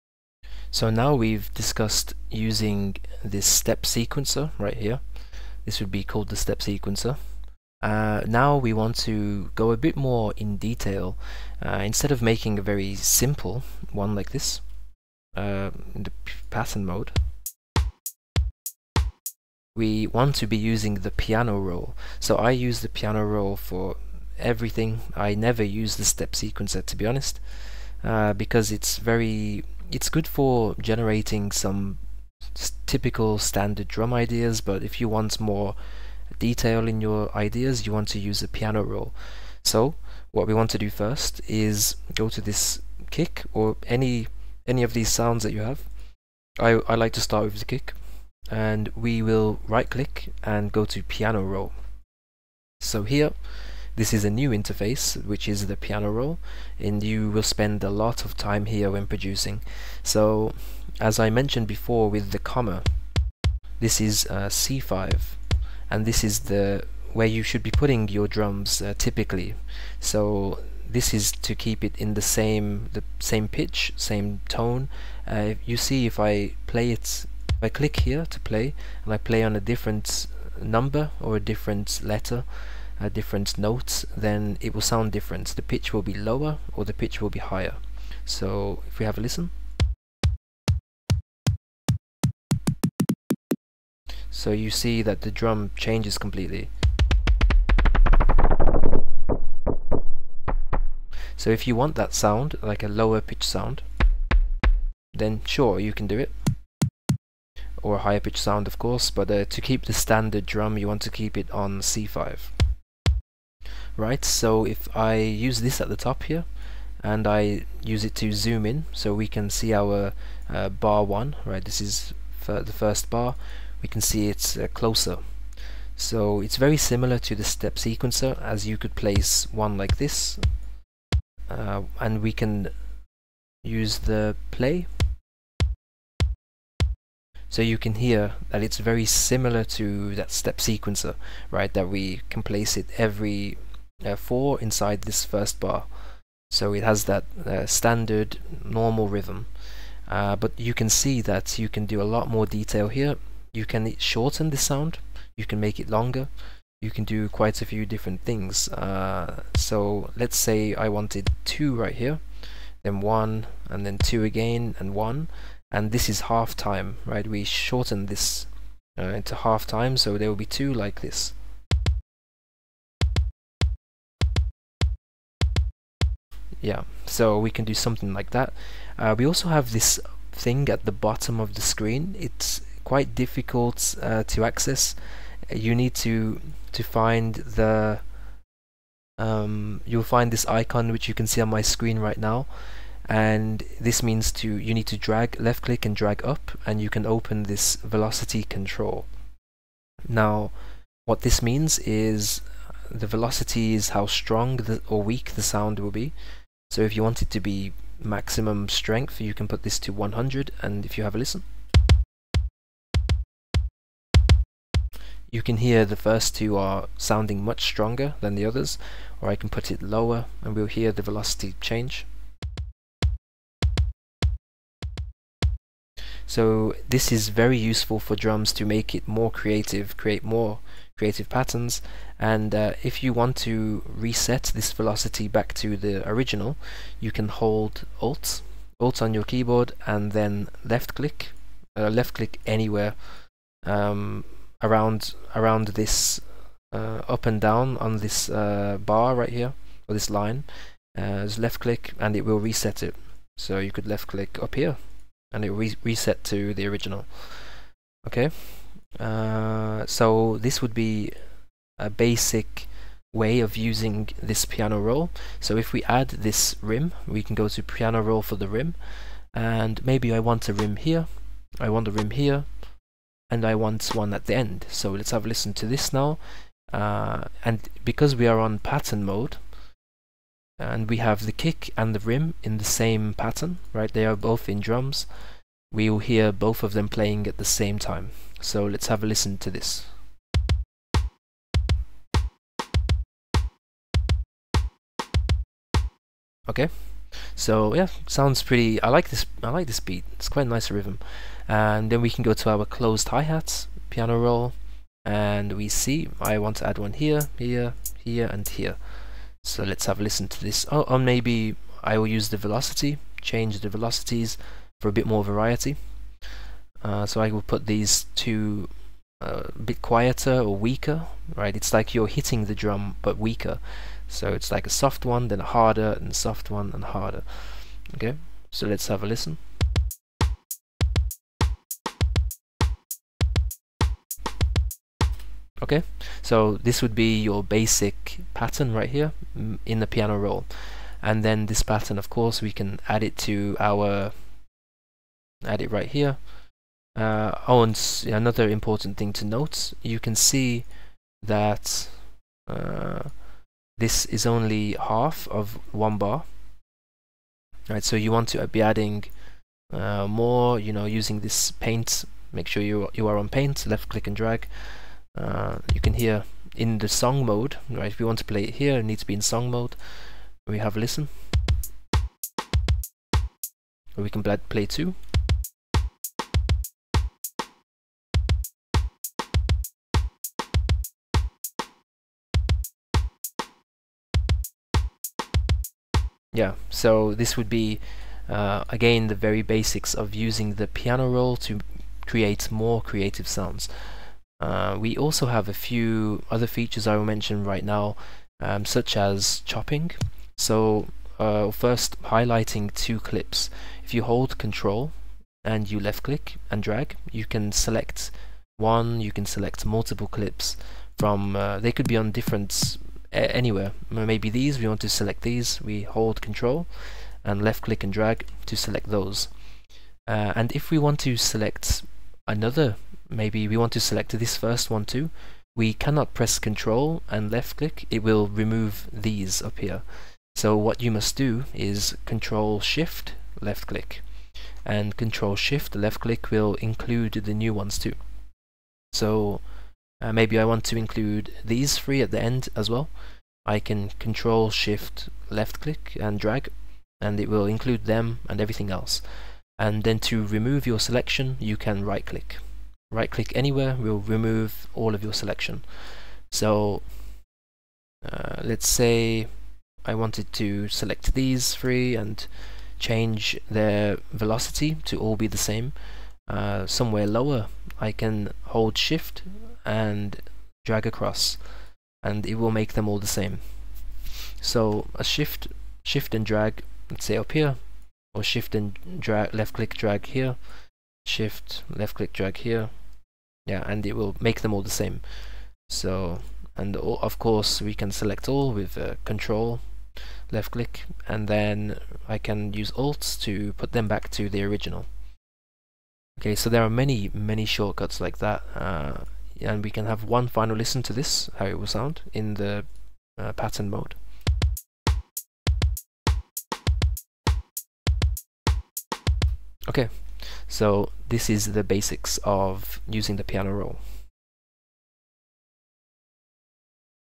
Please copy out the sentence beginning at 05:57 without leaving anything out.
Right, so you want to be adding uh, more, you know, using this paint.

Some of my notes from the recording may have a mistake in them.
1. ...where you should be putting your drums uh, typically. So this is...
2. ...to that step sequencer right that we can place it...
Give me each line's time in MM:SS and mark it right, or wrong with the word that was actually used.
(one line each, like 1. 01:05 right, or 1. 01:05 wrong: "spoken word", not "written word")
1. 01:07 right
2. 02:19 right.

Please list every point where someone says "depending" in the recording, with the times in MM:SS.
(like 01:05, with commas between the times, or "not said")
not said.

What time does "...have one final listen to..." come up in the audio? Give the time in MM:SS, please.
08:19.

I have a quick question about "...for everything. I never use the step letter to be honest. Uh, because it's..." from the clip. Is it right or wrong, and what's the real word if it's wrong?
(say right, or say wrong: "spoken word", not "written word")
wrong: "sequencer", not "letter".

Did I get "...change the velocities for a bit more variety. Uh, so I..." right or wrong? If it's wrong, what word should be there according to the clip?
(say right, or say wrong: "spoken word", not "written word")
right.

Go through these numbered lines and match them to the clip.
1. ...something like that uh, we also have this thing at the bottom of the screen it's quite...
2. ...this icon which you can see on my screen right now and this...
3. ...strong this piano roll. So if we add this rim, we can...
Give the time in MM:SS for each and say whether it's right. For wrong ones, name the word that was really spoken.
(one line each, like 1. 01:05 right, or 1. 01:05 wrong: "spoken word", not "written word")
1. 02:57 right
2. 03:10 right
3. 04:23 wrong: "using", not "strong".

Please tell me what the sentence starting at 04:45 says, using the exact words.
We will hear both of them playing at the same time.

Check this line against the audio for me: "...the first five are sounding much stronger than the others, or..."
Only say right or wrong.
wrong.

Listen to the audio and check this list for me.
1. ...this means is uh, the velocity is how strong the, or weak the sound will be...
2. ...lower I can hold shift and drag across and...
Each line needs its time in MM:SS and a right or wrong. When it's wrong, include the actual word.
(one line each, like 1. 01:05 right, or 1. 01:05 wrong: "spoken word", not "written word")
1. 03:21 right
2. 07:47 right.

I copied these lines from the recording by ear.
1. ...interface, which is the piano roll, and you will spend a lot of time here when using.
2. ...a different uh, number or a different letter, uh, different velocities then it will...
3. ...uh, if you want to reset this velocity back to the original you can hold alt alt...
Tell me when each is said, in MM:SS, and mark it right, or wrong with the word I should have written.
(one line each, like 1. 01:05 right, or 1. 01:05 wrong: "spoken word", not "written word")
1. 00:54 wrong: "producing", not "using"
2. 01:19 wrong: "notes", not "velocities"
3. 03:52 right.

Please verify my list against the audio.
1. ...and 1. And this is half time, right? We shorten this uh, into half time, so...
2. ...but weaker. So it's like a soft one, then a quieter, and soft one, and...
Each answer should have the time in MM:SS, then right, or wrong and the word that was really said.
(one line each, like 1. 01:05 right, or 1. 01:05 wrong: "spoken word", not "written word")
1. 02:44 right
2. 05:23 wrong: "harder", not "quieter".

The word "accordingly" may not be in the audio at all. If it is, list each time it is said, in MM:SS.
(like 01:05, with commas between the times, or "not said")
not said.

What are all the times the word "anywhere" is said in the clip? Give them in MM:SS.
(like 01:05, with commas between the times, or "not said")
04:02, 06:53, 07:33.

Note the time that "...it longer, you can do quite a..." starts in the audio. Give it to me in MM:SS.
02:35.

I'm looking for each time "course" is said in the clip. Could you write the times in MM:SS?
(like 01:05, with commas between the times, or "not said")
01:48, 05:42, 08:07.